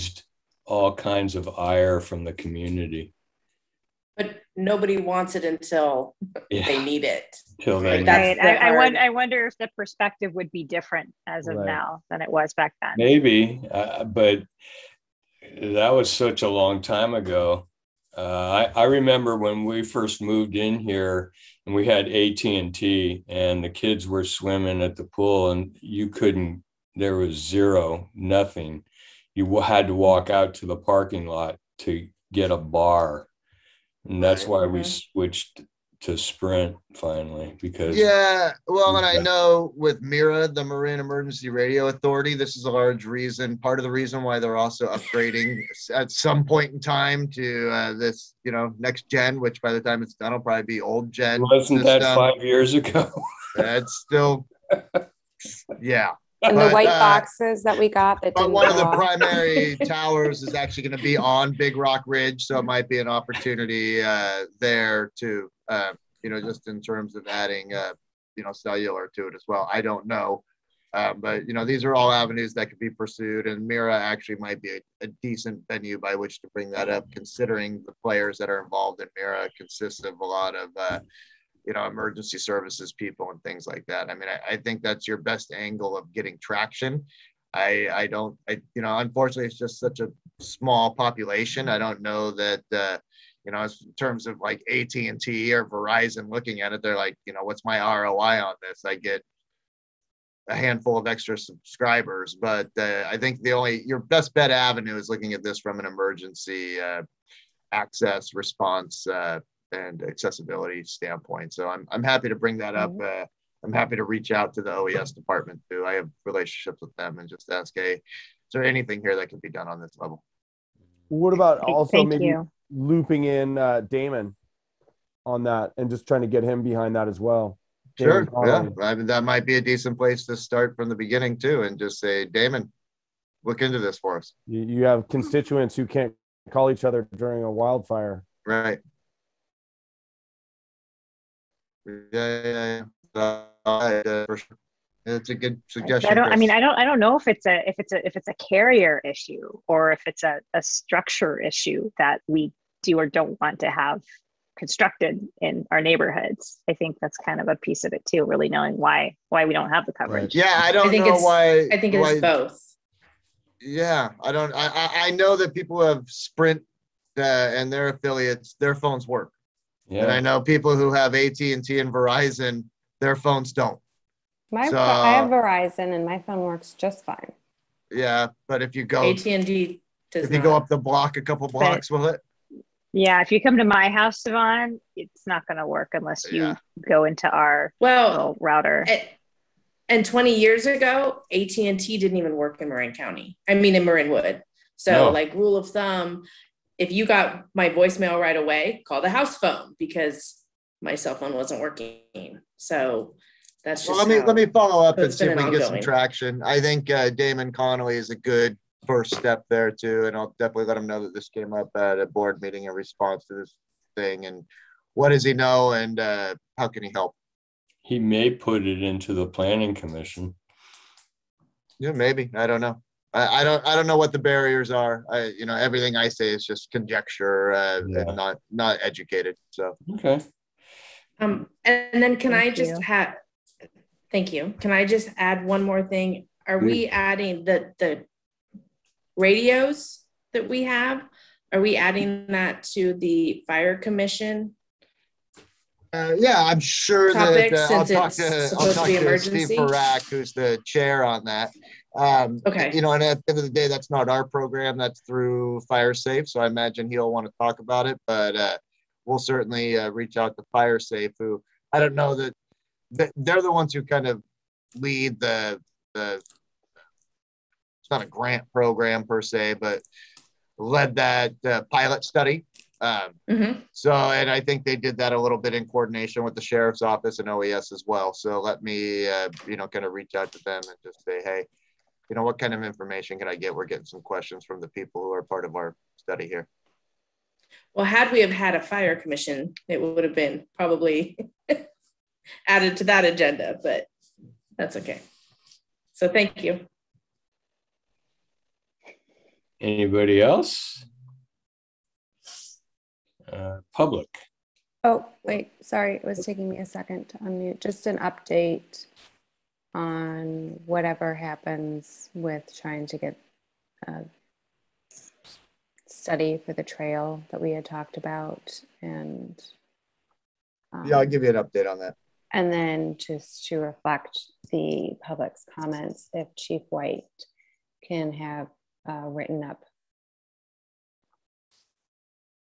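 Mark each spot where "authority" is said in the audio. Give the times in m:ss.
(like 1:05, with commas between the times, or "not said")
0:41.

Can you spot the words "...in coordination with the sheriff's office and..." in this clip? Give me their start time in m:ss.
4:35.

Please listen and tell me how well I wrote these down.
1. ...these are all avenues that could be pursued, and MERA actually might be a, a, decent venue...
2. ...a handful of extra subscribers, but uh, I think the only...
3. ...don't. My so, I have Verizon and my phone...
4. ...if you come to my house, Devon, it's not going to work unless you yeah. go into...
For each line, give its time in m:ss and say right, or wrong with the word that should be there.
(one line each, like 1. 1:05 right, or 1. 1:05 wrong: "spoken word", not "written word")
1. 1:11 right
2. 1:40 right
3. 2:53 right
4. 3:03 right.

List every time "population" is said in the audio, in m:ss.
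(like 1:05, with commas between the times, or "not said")
1:30.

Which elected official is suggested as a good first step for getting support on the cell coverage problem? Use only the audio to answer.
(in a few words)
Damon Connolly.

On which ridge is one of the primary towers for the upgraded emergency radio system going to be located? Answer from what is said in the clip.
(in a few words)
Big Rock Ridge.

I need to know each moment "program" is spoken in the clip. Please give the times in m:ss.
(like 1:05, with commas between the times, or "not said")
4:14, 4:28.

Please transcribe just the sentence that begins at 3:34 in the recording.
And what does he know, and uh, how can he help?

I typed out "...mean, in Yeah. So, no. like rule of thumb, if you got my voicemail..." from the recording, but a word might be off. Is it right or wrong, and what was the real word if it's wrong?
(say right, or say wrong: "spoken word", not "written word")
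wrong: "Marinwood", not "Yeah".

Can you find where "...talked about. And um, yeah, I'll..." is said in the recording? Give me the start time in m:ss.
5:17.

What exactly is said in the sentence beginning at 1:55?
I have relationships with them and just ask, hey, is there anything here that can be done on this level?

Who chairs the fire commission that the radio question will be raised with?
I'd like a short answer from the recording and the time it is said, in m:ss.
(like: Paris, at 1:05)
Steve Barak, at 4:09.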